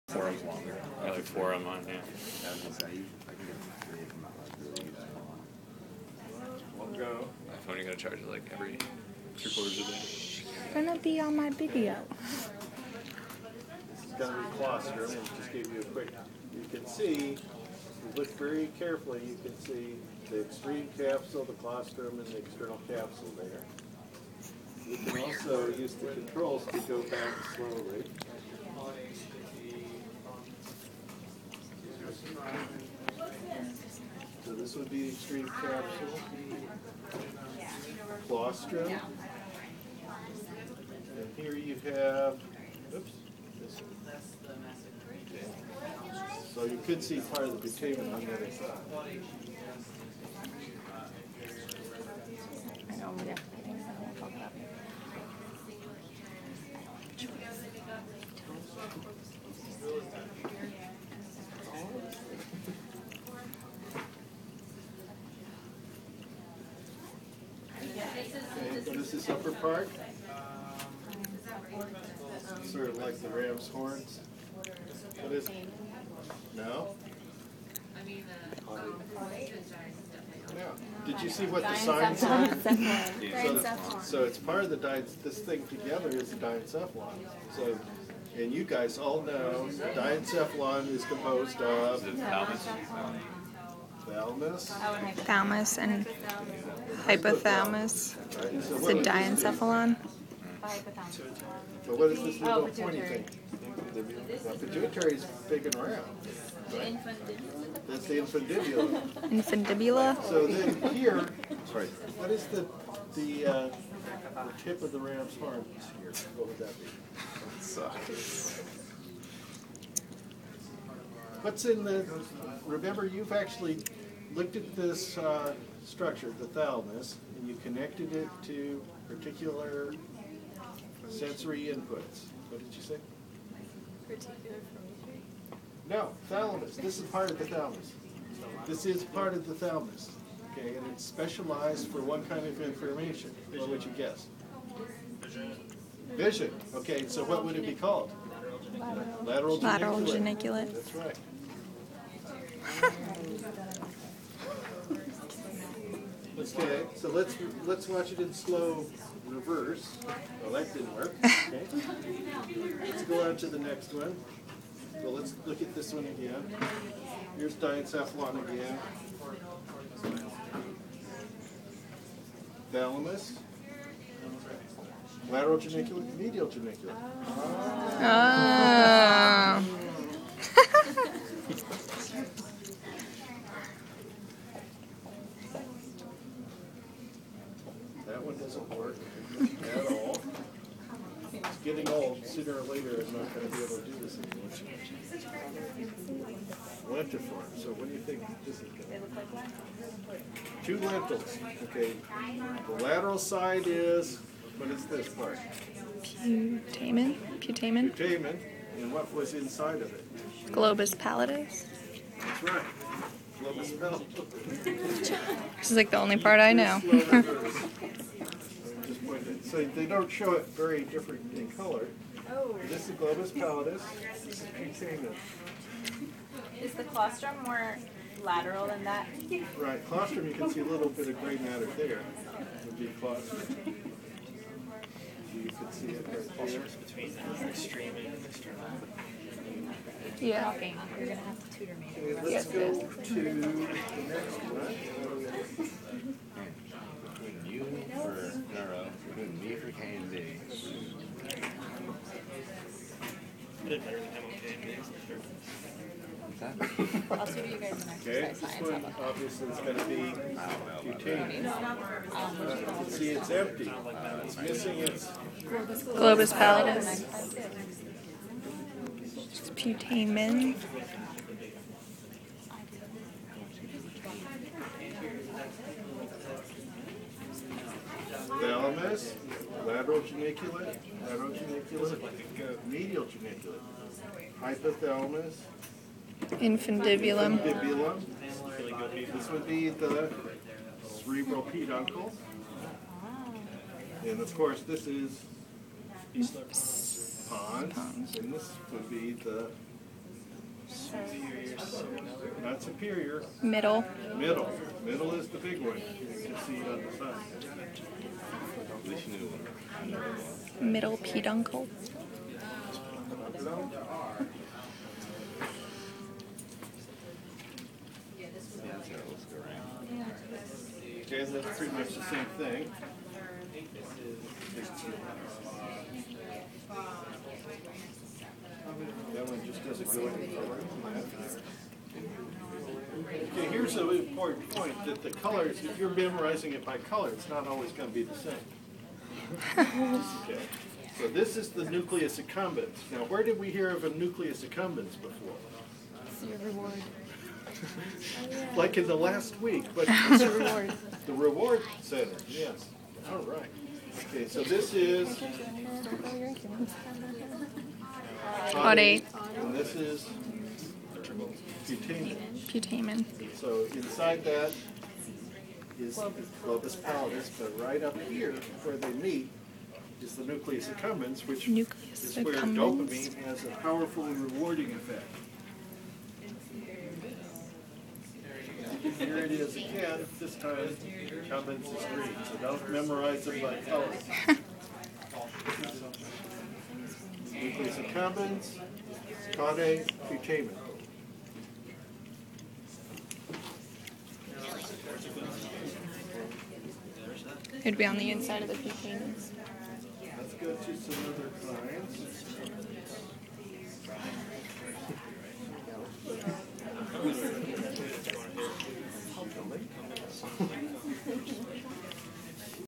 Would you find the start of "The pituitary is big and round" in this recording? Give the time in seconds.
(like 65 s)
103 s.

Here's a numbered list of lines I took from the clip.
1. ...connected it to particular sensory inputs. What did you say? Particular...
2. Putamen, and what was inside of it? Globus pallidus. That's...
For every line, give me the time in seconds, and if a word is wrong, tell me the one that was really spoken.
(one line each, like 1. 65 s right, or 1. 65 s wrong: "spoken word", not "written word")
1. 127 s right
2. 207 s right.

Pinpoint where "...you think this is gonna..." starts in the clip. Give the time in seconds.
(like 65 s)
197 s.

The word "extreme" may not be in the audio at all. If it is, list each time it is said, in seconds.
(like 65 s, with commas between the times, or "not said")
20 s, 35 s, 237 s.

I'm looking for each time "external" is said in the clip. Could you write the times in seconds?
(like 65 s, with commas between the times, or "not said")
22 s, 238 s.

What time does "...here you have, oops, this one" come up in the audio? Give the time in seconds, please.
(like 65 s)
41 s.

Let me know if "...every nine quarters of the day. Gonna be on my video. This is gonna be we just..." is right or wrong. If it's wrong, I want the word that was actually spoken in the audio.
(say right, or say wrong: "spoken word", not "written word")
wrong: "three", not "nine".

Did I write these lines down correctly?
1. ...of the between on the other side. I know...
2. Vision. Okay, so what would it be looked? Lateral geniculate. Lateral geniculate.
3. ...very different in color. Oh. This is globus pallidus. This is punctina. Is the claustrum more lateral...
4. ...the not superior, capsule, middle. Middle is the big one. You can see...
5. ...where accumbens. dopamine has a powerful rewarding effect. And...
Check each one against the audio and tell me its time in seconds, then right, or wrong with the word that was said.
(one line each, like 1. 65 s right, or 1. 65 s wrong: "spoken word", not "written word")
1. 47 s wrong: "putamen", not "between"
2. 146 s wrong: "called", not "looked"
3. 220 s right
4. 299 s wrong: "middle", not "capsule"
5. 372 s right.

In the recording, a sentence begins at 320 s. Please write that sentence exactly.
Okay, that's pretty much the same thing.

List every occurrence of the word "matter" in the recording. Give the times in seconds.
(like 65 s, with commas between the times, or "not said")
231 s.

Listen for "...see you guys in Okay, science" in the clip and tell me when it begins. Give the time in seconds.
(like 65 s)
257 s.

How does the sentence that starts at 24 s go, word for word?
You can also use the controls to go back slowly.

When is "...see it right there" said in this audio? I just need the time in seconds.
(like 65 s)
235 s.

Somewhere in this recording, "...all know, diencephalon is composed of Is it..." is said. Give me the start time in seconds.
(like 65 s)
88 s.